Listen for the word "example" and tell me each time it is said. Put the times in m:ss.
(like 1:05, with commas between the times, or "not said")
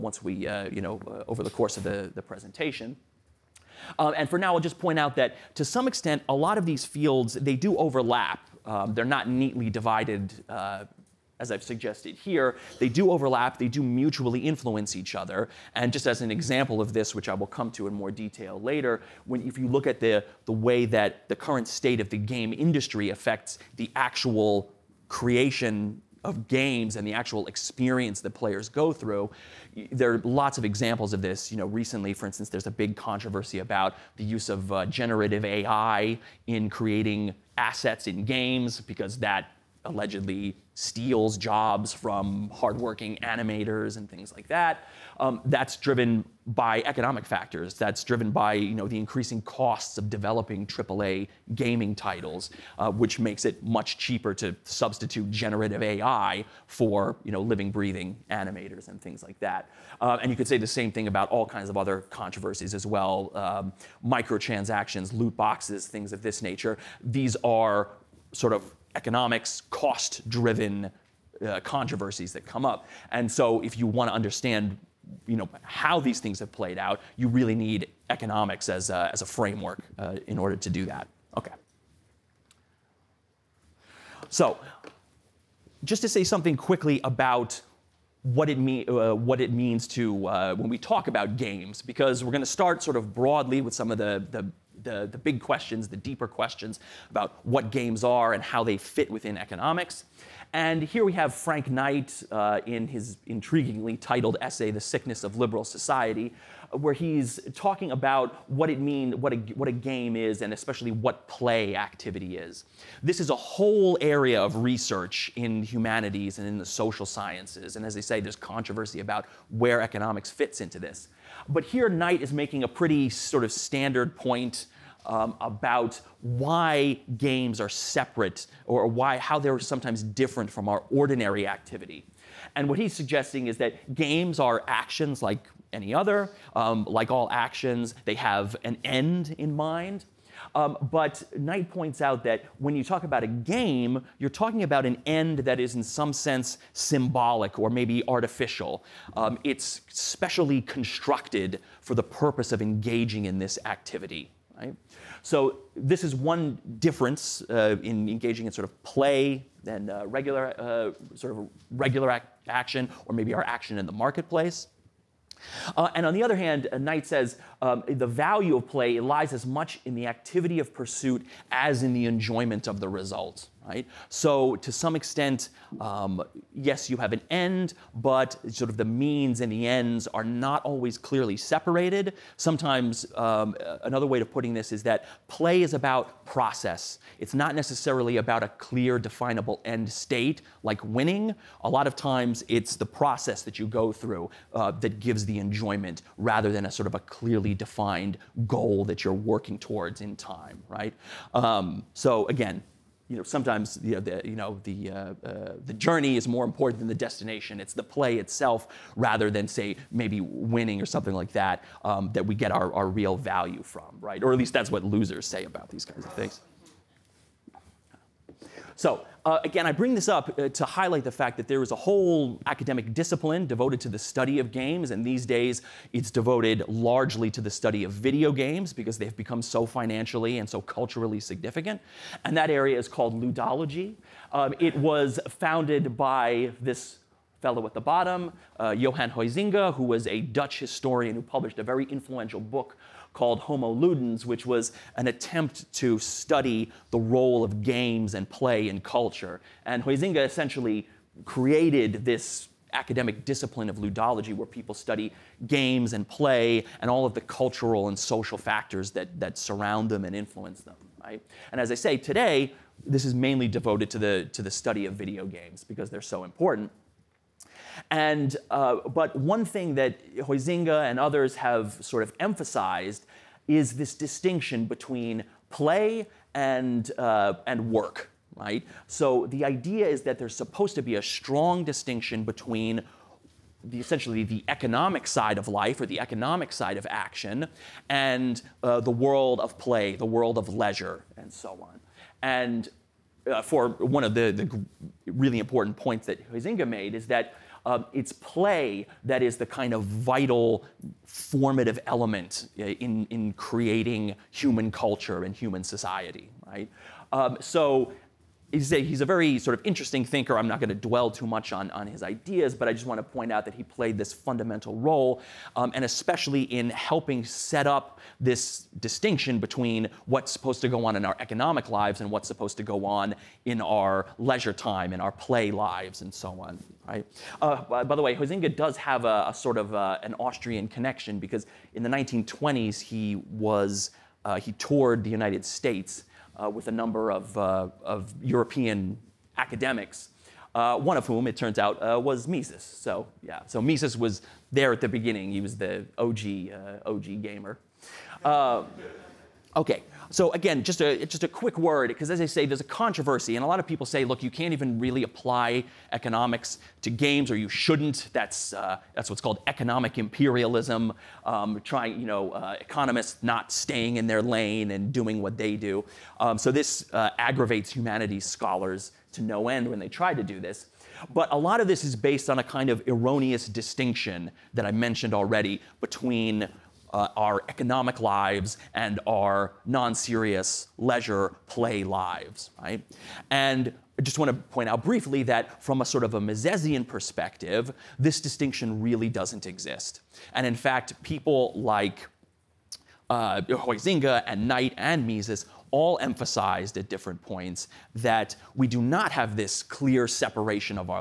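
0:16, 0:30.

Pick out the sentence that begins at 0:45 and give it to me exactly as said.
Um, that's driven by economic factors.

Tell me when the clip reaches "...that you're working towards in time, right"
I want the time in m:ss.
3:18.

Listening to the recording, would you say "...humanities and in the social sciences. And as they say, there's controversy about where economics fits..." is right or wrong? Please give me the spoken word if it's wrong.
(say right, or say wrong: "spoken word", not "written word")
right.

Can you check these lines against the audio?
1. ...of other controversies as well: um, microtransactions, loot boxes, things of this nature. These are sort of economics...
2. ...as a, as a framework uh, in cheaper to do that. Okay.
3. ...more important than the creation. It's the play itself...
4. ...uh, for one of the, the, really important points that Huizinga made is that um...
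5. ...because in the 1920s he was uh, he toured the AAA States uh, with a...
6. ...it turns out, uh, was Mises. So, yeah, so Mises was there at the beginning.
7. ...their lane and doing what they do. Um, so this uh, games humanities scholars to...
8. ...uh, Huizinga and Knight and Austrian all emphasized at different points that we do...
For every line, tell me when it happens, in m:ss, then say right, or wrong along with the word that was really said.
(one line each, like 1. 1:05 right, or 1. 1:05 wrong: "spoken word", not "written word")
1. 1:01 right
2. 1:18 wrong: "order", not "cheaper"
3. 3:26 wrong: "destination", not "creation"
4. 4:53 right
5. 5:31 wrong: "United", not "AAA"
6. 5:41 right
7. 6:04 wrong: "aggravates", not "games"
8. 6:33 wrong: "Mises", not "Austrian".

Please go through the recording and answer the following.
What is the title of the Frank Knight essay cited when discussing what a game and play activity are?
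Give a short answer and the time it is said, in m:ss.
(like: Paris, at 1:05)
The Sickness of Liberal Society, at 1:44.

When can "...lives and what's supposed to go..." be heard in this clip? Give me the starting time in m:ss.
5:21.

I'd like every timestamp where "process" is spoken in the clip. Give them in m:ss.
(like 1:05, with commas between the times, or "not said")
3:06, 3:12.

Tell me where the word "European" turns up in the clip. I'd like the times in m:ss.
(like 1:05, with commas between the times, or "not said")
5:38.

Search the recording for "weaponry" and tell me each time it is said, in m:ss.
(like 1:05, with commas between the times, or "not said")
not said.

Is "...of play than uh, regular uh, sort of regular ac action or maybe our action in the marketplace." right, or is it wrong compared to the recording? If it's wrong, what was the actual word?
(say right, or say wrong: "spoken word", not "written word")
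right.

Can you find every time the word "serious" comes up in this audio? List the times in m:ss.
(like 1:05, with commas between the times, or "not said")
6:19.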